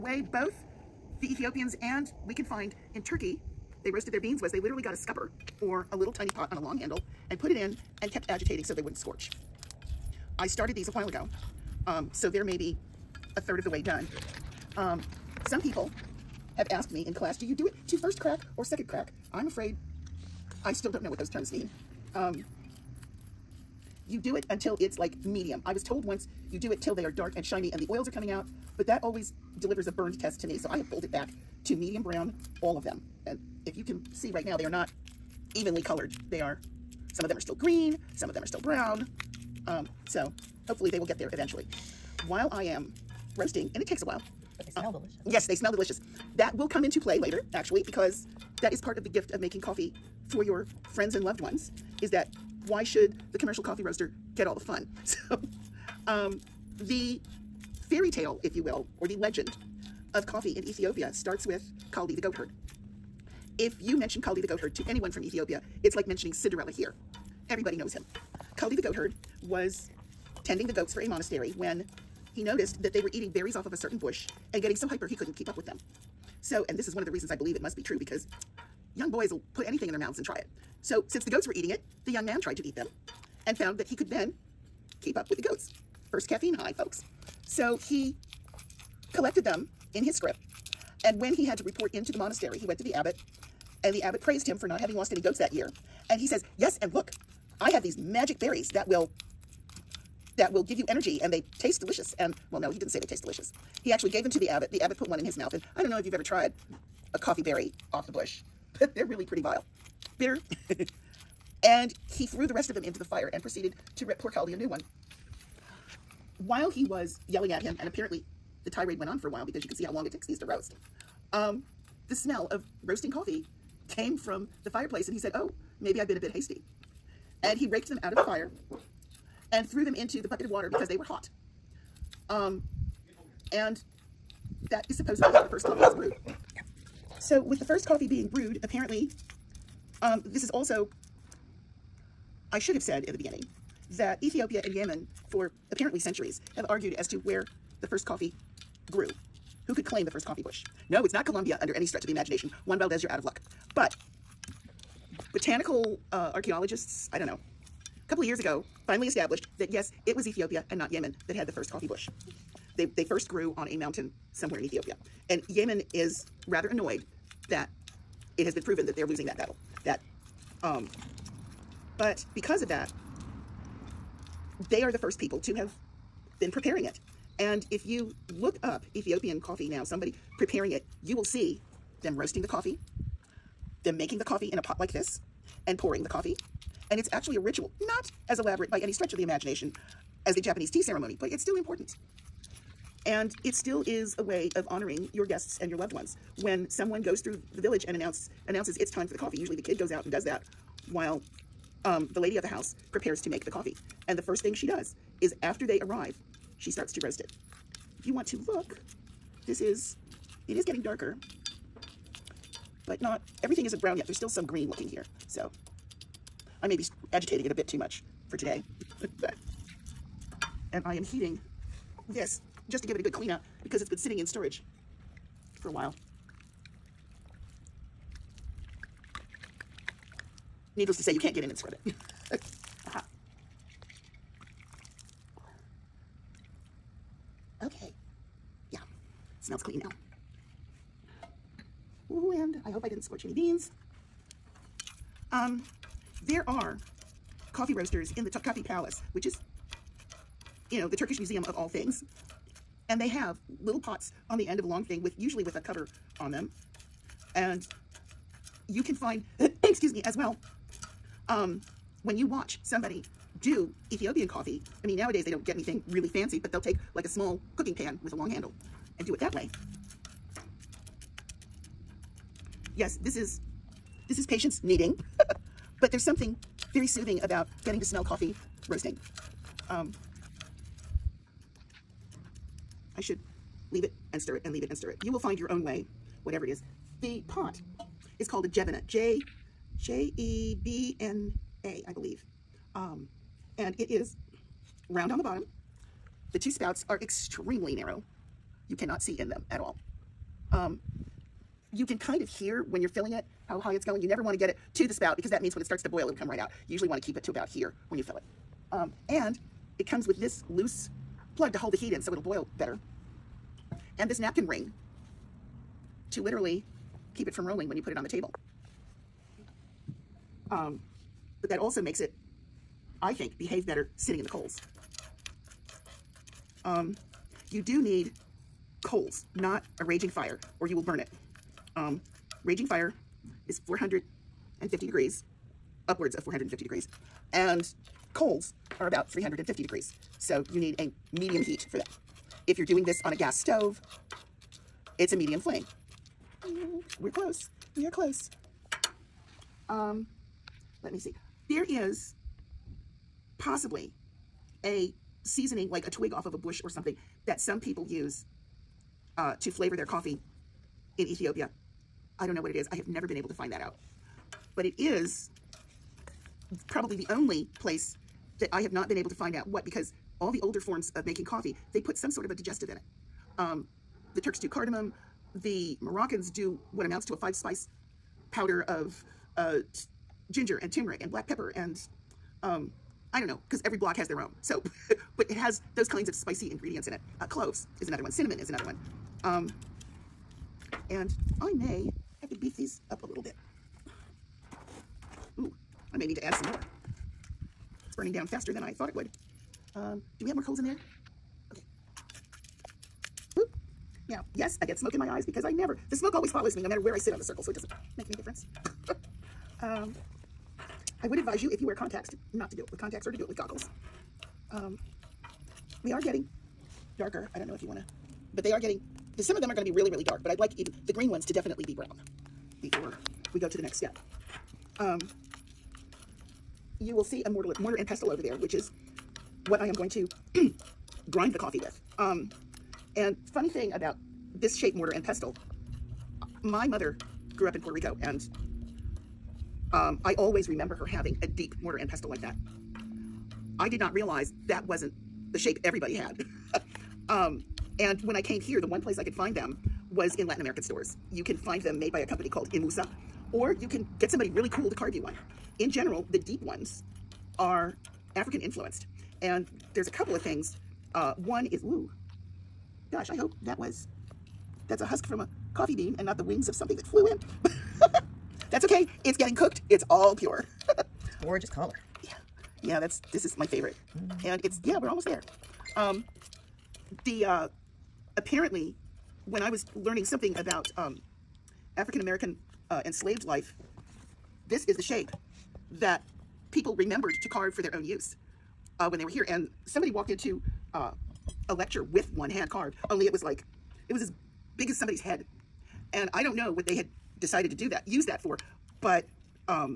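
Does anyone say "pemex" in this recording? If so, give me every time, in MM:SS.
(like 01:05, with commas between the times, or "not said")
not said.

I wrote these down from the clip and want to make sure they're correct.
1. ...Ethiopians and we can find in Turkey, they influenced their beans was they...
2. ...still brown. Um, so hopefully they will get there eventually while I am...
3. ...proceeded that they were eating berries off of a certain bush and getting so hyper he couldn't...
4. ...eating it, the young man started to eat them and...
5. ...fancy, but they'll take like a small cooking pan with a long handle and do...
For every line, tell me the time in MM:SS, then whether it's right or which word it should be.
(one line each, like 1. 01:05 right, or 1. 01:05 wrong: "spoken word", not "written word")
1. 00:01 wrong: "roasted", not "influenced"
2. 00:38 right
3. 01:12 wrong: "noticed", not "proceeded"
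4. 01:21 wrong: "tried", not "started"
5. 04:26 right.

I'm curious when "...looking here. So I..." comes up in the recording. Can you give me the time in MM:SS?
03:34.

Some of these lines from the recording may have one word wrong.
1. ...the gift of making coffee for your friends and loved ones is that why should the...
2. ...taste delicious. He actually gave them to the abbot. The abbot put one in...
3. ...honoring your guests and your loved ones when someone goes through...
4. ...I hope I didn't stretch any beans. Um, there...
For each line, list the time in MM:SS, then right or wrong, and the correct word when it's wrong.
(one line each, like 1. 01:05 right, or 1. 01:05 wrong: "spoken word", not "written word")
1. 00:49 right
2. 01:43 right
3. 03:14 right
4. 04:02 wrong: "scorch", not "stretch".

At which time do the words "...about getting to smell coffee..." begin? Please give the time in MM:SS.
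04:37.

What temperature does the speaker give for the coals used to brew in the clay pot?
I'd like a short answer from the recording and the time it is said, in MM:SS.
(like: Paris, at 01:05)
350 degrees, at 05:39.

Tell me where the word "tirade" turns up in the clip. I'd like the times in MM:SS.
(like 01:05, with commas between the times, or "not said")
01:58.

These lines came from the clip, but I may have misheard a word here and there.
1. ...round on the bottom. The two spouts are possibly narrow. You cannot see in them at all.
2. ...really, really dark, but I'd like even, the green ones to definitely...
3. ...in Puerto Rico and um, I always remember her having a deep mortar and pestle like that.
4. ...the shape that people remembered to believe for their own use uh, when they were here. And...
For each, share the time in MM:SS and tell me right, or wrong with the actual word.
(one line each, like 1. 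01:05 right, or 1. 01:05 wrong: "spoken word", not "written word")
1. 04:54 wrong: "extremely", not "possibly"
2. 06:59 right
3. 07:17 right
4. 08:04 wrong: "carve", not "believe".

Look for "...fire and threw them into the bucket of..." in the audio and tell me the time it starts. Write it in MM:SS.
02:08.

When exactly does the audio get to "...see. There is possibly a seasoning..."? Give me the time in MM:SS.
05:50.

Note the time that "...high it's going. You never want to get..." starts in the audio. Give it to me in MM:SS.
05:03.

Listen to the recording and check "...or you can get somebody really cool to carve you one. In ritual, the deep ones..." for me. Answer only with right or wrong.
wrong.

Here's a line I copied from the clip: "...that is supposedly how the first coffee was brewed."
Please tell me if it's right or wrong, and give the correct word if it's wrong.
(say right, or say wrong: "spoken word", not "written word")
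right.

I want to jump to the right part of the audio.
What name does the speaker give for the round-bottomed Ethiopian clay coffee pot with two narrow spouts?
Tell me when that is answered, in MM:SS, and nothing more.
04:48.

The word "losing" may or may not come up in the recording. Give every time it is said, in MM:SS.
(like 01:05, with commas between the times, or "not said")
02:49.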